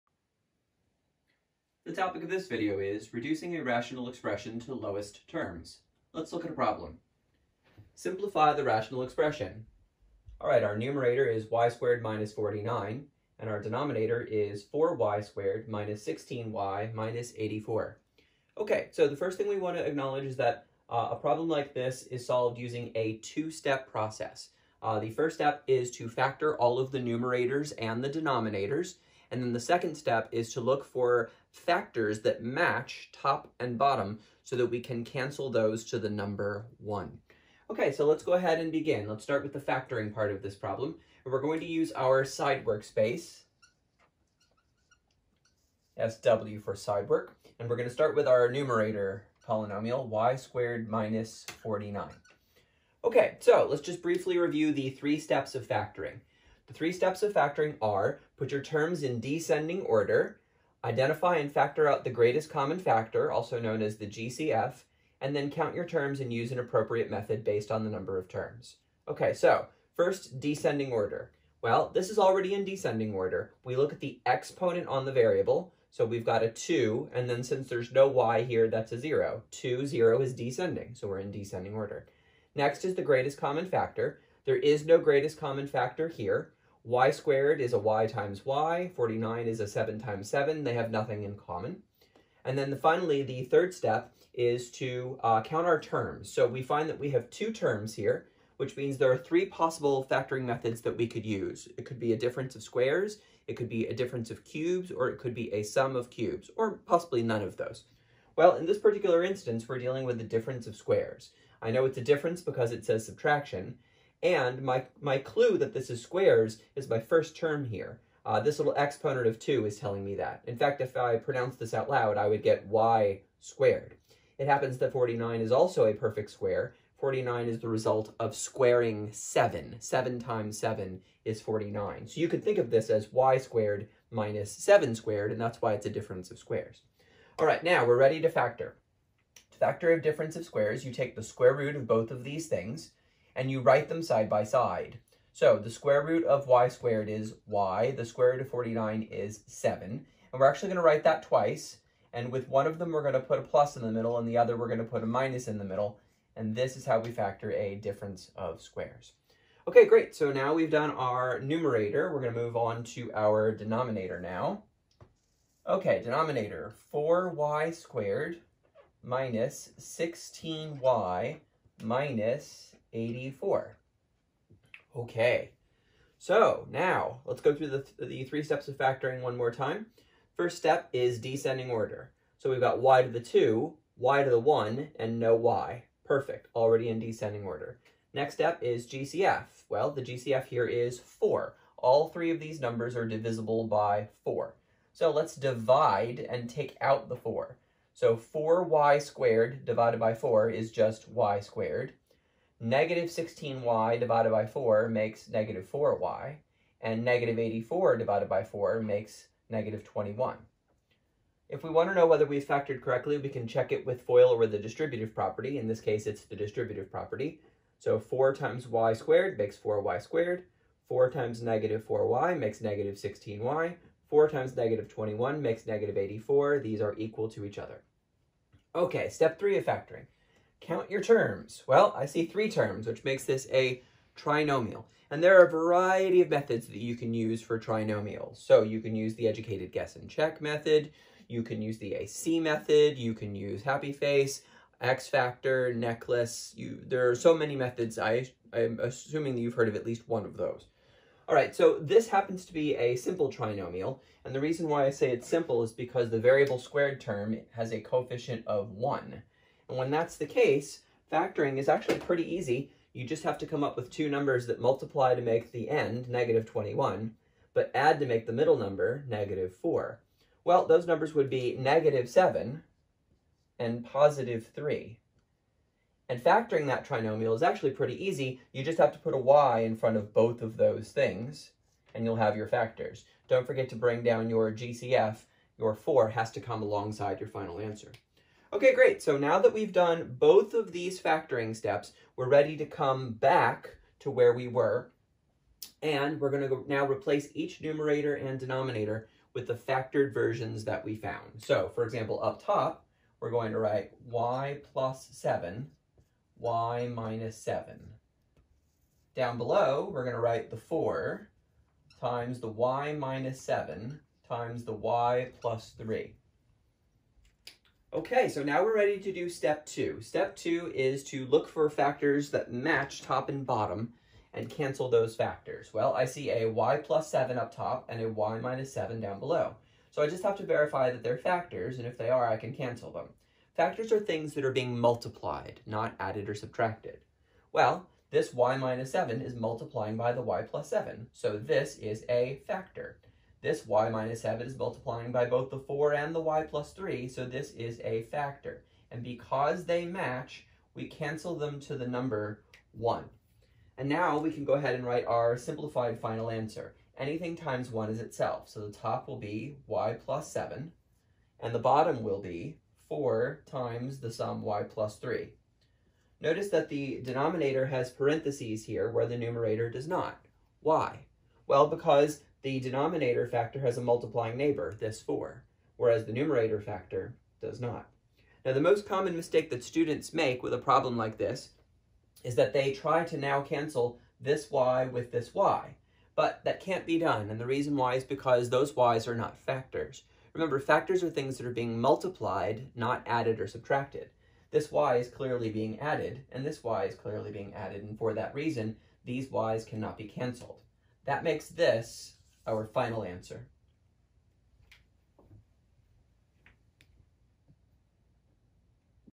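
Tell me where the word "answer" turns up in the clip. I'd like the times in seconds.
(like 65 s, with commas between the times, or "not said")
287 s, 356 s, 403 s.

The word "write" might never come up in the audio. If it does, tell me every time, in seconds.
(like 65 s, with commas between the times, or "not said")
143 s, 150 s, 303 s, 310 s, 354 s.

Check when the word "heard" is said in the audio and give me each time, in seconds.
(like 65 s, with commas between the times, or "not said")
249 s.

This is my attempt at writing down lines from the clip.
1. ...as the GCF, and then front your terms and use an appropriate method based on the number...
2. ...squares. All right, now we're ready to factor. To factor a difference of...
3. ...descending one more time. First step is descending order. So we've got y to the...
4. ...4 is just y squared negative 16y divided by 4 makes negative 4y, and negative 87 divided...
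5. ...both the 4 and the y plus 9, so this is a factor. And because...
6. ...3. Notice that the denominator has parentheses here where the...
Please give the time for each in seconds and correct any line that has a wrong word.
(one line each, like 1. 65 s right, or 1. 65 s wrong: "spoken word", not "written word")
1. 63 s wrong: "count", not "front"
2. 136 s right
3. 178 s wrong: "factoring", not "descending"
4. 200 s wrong: "84", not "87"
5. 345 s wrong: "3", not "9"
6. 364 s right.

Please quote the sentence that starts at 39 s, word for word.
Let's start with the factoring part of this problem.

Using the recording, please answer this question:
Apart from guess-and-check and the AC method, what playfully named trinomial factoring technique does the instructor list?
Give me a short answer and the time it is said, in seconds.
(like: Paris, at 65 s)
Happy face, at 243 s.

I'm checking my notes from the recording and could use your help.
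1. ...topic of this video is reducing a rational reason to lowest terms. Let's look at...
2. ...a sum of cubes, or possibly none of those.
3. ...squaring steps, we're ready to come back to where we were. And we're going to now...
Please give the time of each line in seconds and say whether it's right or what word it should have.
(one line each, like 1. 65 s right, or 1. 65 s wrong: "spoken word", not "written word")
1. 2 s wrong: "expression", not "reason"
2. 105 s right
3. 291 s wrong: "factoring", not "squaring".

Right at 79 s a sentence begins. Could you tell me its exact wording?
2, 0 is descending, so we're in descending order.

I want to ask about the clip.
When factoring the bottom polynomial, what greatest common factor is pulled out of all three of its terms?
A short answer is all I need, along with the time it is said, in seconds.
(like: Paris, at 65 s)
4, at 189 s.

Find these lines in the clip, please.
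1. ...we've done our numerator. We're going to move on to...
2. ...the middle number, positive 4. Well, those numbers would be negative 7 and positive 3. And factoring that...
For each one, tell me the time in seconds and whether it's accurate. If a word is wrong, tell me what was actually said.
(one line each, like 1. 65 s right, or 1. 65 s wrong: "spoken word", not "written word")
1. 160 s right
2. 268 s wrong: "negative", not "positive".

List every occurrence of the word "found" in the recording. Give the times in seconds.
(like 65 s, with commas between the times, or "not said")
300 s.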